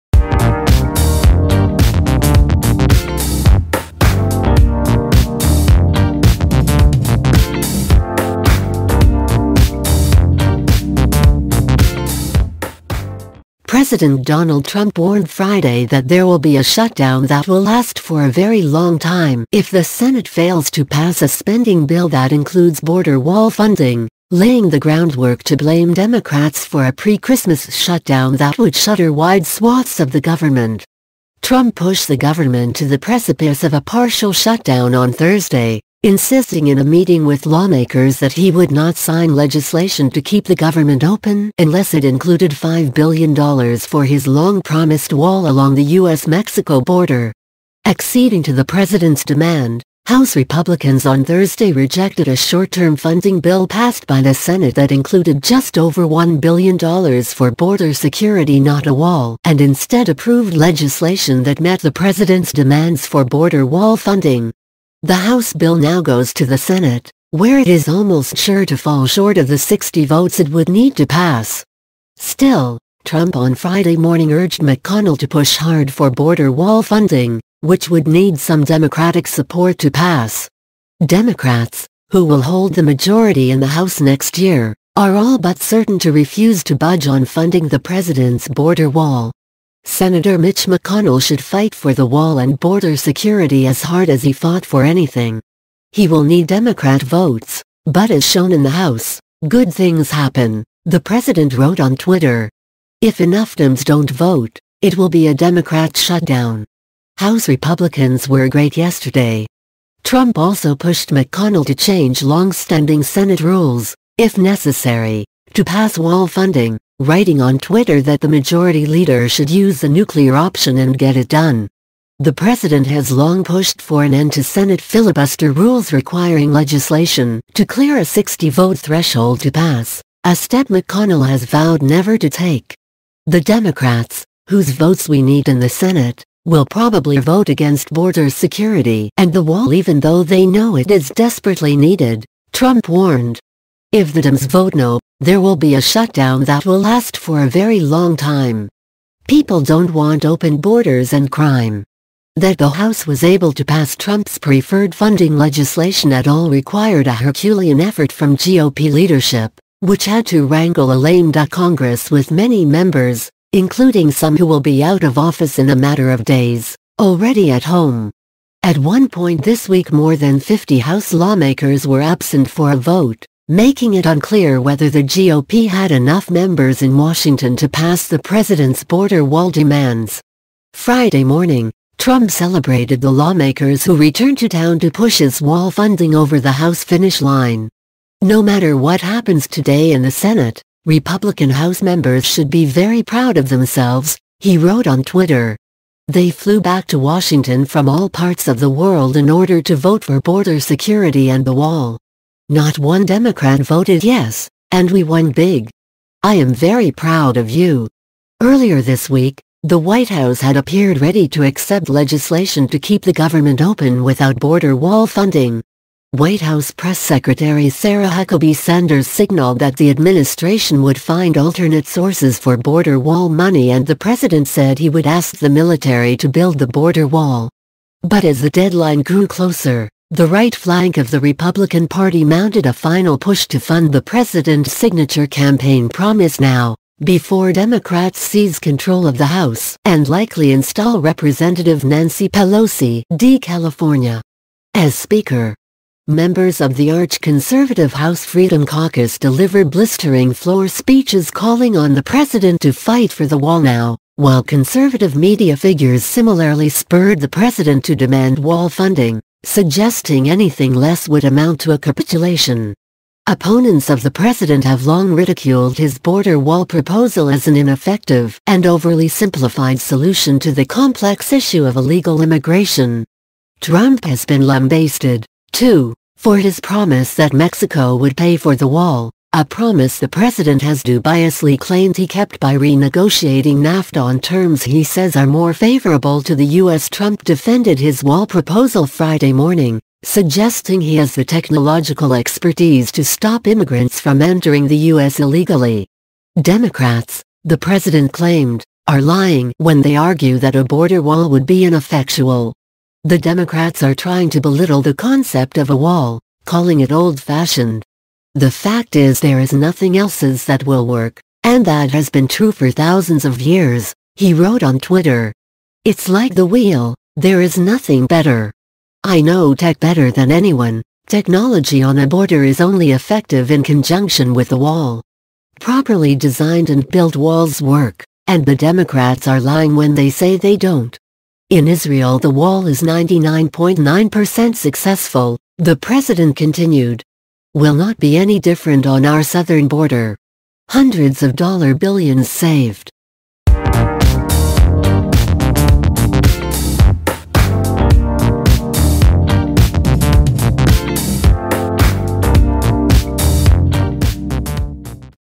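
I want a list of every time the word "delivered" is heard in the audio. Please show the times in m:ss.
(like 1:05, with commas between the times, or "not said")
4:09.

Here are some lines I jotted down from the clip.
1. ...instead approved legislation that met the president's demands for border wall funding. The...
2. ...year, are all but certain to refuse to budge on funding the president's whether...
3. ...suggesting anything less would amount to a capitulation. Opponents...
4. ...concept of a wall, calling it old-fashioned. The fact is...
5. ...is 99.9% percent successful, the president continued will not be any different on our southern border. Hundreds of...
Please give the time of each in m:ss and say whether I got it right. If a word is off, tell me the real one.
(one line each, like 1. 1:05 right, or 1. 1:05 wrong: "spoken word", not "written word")
1. 0:59 right
2. 1:24 wrong: "border", not "whether"
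3. 4:19 right
4. 5:04 right
5. 5:32 right.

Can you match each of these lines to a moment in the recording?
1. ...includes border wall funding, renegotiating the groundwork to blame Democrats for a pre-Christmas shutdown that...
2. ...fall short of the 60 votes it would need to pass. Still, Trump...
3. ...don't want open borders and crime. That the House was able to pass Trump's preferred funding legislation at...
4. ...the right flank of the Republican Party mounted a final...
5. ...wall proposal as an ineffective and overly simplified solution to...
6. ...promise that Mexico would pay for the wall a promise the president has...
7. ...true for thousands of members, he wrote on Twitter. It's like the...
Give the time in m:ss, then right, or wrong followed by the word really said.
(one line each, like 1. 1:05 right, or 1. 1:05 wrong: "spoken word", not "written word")
1. 0:22 wrong: "laying", not "renegotiating"
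2. 1:08 right
3. 2:29 right
4. 3:50 right
5. 4:26 right
6. 4:36 right
7. 5:12 wrong: "years", not "members".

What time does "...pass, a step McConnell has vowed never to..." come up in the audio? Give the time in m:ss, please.
2:09.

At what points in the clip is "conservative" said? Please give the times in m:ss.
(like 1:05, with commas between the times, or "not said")
4:06, 4:14.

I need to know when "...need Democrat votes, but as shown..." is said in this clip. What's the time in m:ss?
1:36.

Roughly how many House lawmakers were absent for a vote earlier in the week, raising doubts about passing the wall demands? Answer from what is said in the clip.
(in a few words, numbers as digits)
more than 50.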